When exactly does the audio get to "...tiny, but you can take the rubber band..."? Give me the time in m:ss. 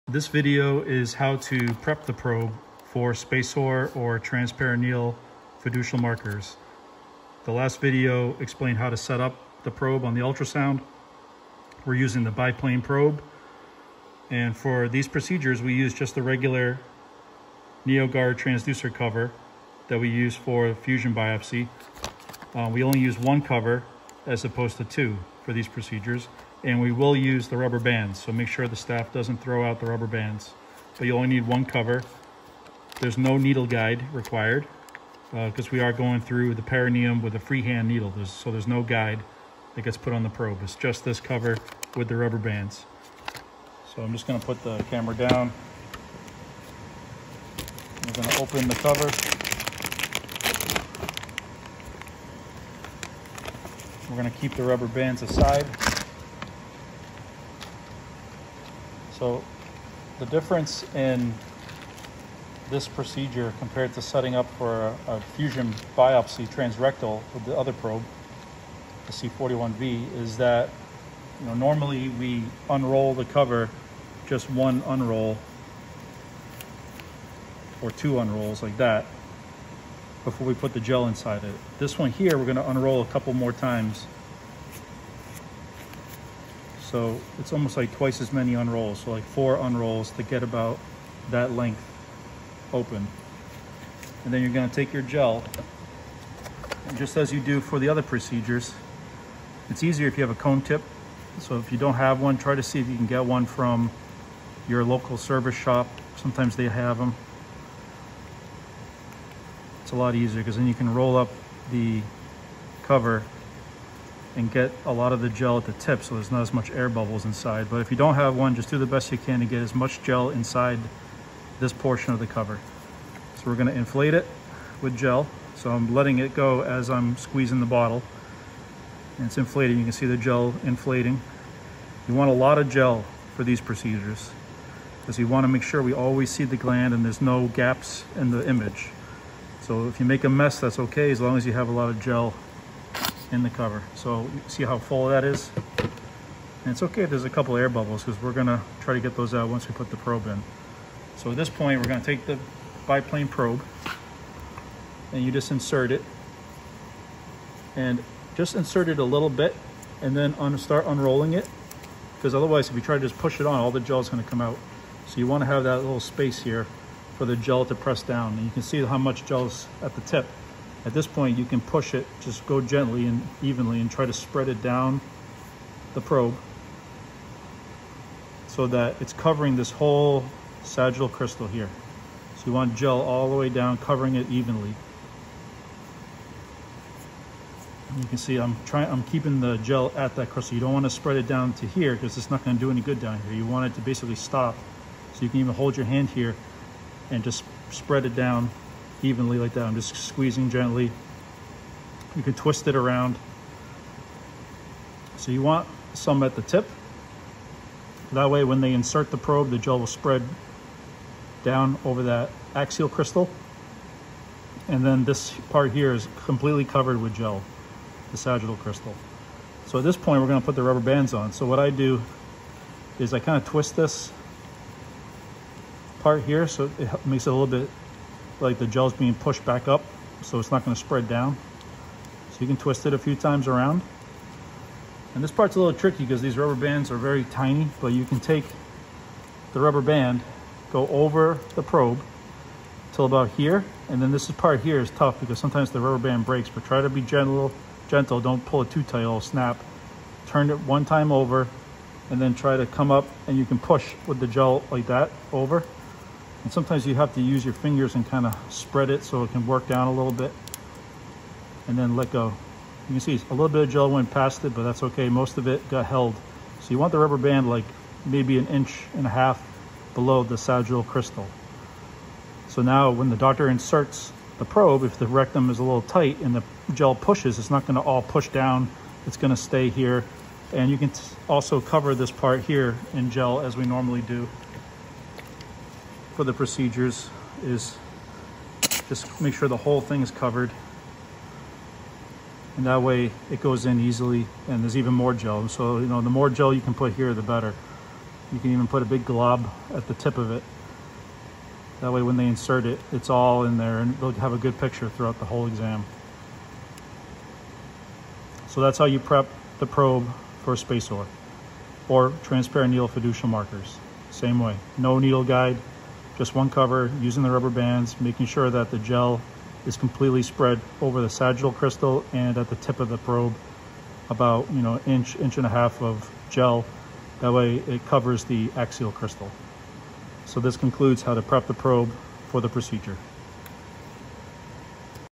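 3:57.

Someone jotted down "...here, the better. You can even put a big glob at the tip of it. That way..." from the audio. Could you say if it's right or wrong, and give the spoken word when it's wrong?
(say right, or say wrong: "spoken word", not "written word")
right.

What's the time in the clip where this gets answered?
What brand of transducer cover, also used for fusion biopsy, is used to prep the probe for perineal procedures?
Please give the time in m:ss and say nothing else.
0:17.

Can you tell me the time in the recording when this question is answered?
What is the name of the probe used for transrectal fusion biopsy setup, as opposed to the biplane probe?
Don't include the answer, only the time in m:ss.
1:09.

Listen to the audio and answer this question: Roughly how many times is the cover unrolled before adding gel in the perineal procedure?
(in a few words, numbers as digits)
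4.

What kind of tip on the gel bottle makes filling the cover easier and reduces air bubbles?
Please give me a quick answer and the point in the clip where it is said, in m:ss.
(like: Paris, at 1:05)
cone tip, at 1:40.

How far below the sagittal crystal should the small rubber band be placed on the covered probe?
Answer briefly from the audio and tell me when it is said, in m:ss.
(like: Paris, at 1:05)
1.5 inches, at 4:28.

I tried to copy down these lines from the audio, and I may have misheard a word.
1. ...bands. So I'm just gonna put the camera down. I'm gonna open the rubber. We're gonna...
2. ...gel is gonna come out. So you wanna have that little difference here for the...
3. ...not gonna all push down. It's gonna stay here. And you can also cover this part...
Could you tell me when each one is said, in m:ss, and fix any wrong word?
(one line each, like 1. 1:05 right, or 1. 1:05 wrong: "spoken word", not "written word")
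1. 0:42 wrong: "cover", not "rubber"
2. 2:43 wrong: "space", not "difference"
3. 4:37 right.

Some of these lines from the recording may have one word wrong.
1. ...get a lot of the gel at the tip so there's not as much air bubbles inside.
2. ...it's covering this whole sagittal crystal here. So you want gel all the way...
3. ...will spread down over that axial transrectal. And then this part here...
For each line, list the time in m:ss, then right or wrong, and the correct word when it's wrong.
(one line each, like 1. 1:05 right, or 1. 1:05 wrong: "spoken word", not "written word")
1. 1:54 right
2. 2:58 right
3. 3:29 wrong: "crystal", not "transrectal".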